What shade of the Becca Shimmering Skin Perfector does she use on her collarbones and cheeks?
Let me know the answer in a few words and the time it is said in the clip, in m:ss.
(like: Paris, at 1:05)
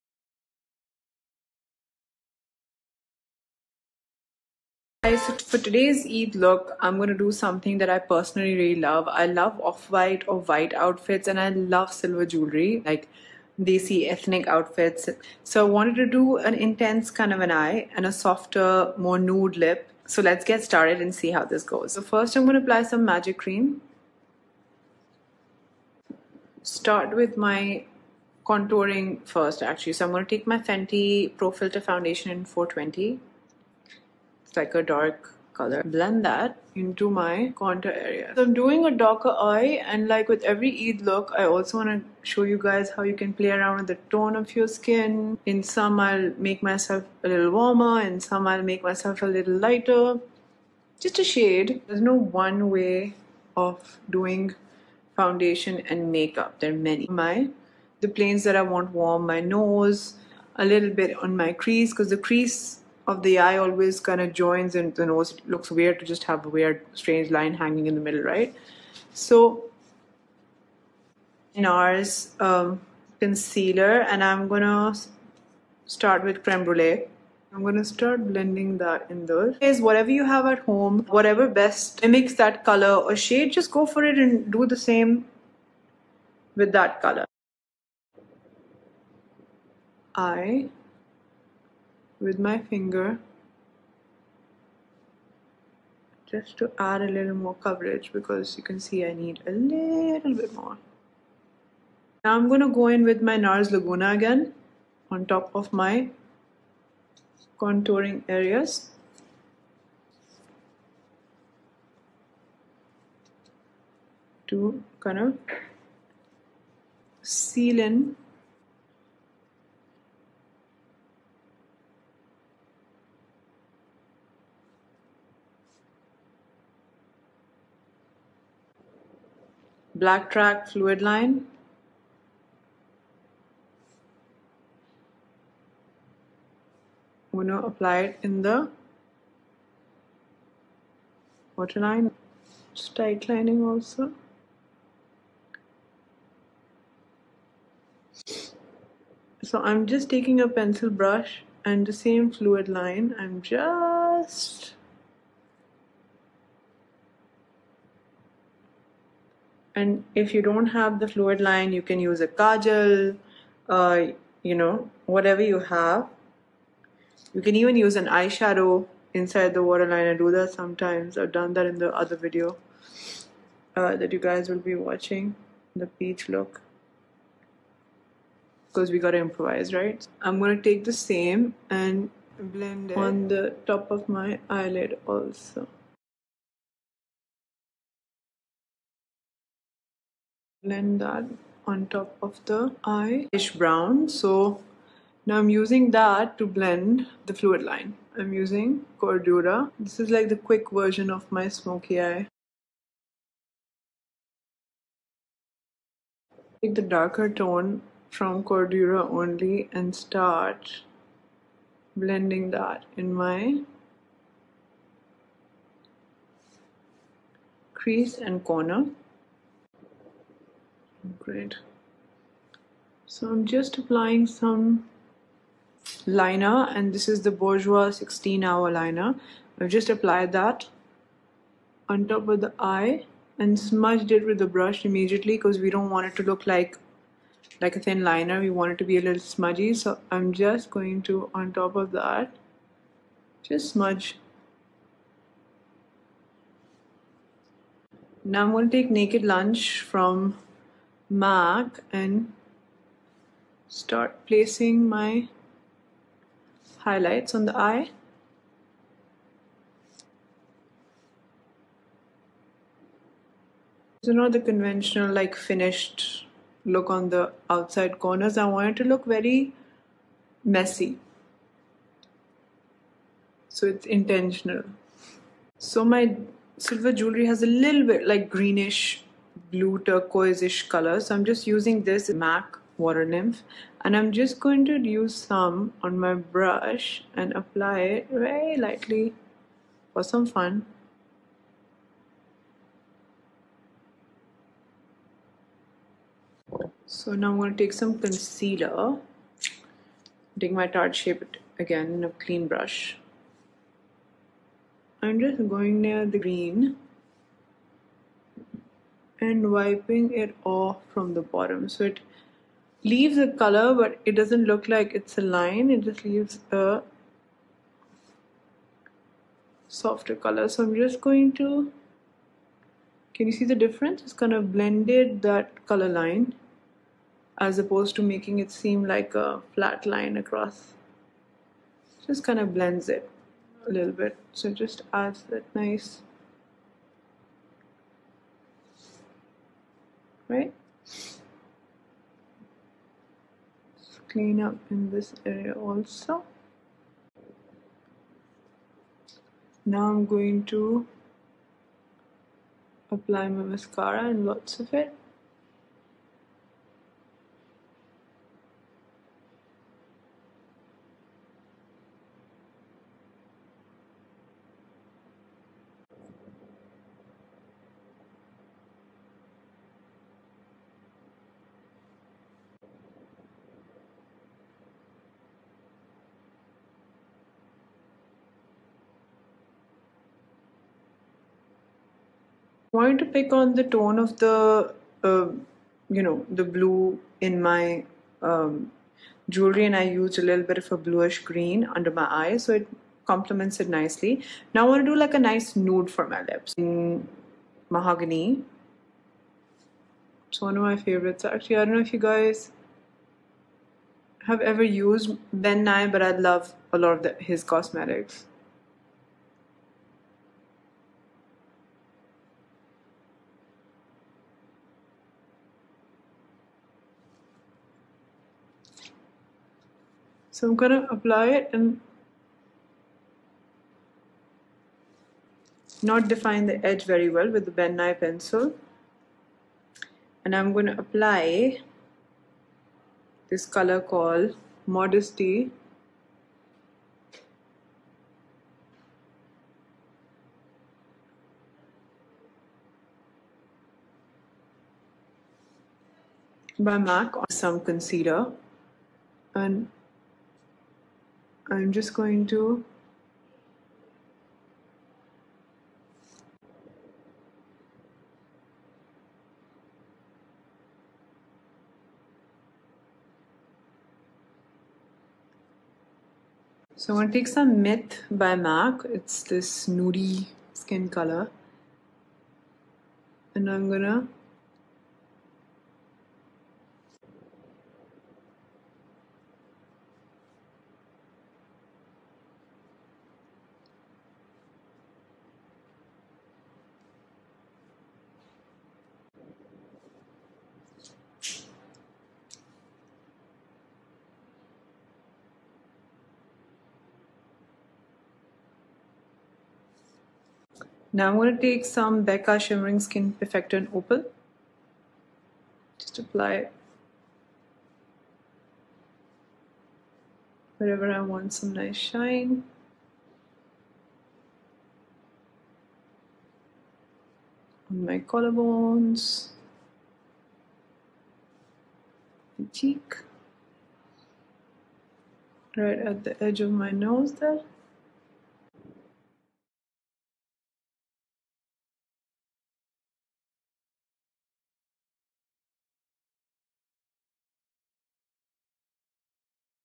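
Opal, at 8:23.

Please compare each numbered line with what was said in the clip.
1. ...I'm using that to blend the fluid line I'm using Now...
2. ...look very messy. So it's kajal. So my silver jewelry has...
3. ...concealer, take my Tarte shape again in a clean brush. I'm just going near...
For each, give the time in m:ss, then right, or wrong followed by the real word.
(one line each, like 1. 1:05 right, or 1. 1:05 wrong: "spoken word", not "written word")
1. 3:15 wrong: "Cordura", not "Now"
2. 4:28 wrong: "intentional", not "kajal"
3. 4:57 right.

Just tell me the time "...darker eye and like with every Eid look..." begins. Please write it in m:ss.
0:38.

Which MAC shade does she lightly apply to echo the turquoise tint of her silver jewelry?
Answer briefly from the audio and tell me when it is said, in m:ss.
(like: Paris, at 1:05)
Water Nymph, at 4:42.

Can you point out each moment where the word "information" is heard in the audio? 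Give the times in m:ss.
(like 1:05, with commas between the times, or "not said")
not said.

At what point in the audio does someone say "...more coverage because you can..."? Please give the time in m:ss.
1:37.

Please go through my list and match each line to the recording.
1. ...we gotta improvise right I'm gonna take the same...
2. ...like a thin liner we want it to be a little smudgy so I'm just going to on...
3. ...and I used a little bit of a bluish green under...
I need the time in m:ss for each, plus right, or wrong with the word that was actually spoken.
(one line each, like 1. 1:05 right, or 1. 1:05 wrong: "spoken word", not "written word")
1. 2:58 right
2. 3:57 right
3. 6:29 right.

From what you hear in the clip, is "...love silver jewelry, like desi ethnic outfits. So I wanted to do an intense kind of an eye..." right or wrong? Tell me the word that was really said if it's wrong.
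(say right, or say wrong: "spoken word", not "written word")
right.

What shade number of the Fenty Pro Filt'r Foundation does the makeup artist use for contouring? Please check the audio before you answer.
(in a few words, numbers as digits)
420.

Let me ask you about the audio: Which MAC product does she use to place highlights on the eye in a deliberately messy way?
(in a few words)
Naked Lunch.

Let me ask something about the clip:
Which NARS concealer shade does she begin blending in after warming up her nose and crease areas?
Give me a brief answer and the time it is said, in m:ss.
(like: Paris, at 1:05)
Creme Brulee, at 1:16.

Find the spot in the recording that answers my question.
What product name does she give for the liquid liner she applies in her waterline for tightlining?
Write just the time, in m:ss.
2:10.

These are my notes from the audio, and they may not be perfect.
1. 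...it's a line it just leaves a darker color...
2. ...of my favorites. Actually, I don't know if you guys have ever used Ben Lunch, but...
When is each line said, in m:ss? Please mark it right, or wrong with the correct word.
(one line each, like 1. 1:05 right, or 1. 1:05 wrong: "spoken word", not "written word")
1. 5:14 wrong: "softer", not "darker"
2. 6:40 wrong: "Nye", not "Lunch".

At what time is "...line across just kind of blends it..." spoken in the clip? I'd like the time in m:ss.
5:29.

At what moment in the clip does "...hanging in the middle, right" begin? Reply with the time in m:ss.
1:07.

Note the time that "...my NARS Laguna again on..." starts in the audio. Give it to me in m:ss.
1:43.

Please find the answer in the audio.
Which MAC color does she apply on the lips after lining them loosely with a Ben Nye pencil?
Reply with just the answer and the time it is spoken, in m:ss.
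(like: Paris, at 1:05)
Modesty, at 7:14.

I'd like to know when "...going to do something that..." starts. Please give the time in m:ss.
0:06.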